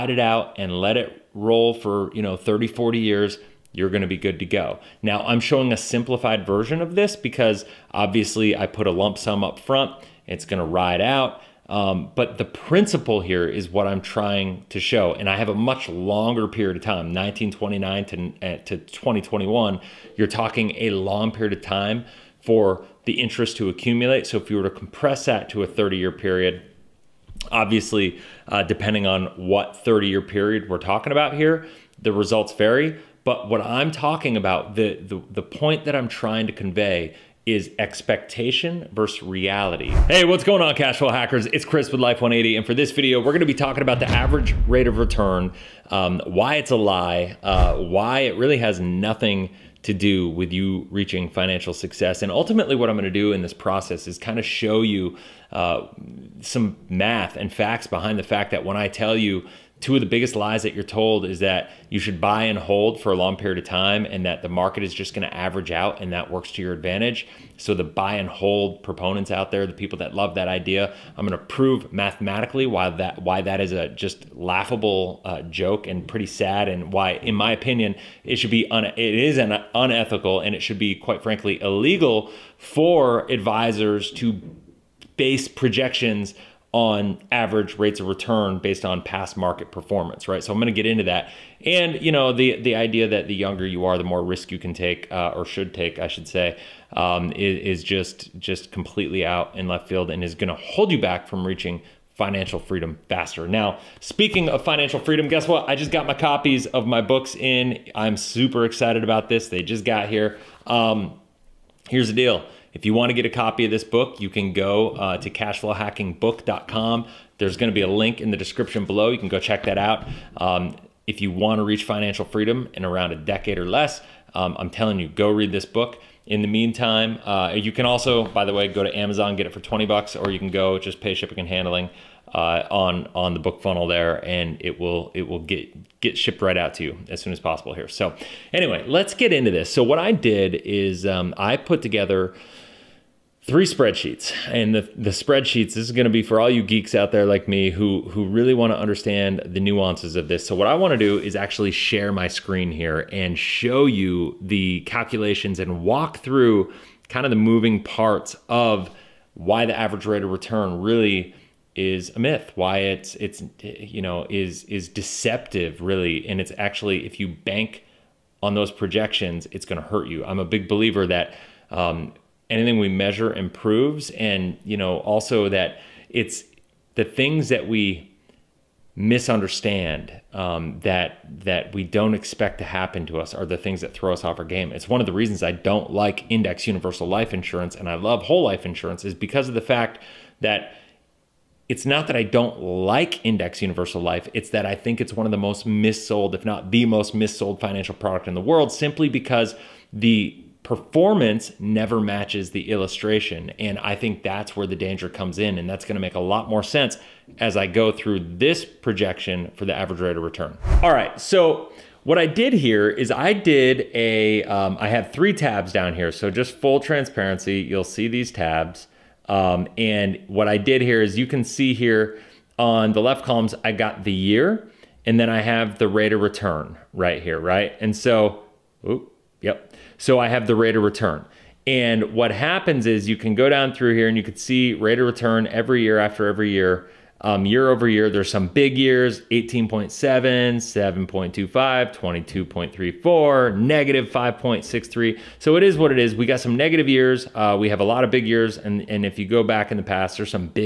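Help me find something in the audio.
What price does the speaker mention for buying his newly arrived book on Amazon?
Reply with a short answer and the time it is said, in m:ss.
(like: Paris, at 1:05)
20 bucks, at 2:09.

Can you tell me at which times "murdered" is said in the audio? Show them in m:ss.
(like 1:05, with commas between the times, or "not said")
not said.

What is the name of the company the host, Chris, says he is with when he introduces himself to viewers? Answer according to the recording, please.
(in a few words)
Life 180.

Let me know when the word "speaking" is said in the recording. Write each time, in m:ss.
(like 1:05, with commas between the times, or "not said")
1:44.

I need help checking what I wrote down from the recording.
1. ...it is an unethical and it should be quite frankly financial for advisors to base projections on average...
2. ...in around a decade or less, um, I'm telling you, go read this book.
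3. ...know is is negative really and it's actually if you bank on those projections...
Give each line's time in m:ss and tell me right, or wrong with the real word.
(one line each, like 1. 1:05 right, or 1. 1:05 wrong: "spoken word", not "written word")
1. 1:18 wrong: "illegal", not "financial"
2. 2:02 right
3. 2:44 wrong: "deceptive", not "negative".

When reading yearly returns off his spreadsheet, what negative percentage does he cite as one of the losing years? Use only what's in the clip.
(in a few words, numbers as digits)
-5.63.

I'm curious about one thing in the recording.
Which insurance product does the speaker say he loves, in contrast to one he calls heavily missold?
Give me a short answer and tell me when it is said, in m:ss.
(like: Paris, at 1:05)
whole life insurance, at 3:08.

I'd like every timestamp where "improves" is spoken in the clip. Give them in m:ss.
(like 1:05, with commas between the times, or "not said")
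2:53.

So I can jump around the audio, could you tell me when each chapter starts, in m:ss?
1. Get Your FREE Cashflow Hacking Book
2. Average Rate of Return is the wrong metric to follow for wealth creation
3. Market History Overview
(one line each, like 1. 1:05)
1. 1:46
2. 2:17
3. 3:37.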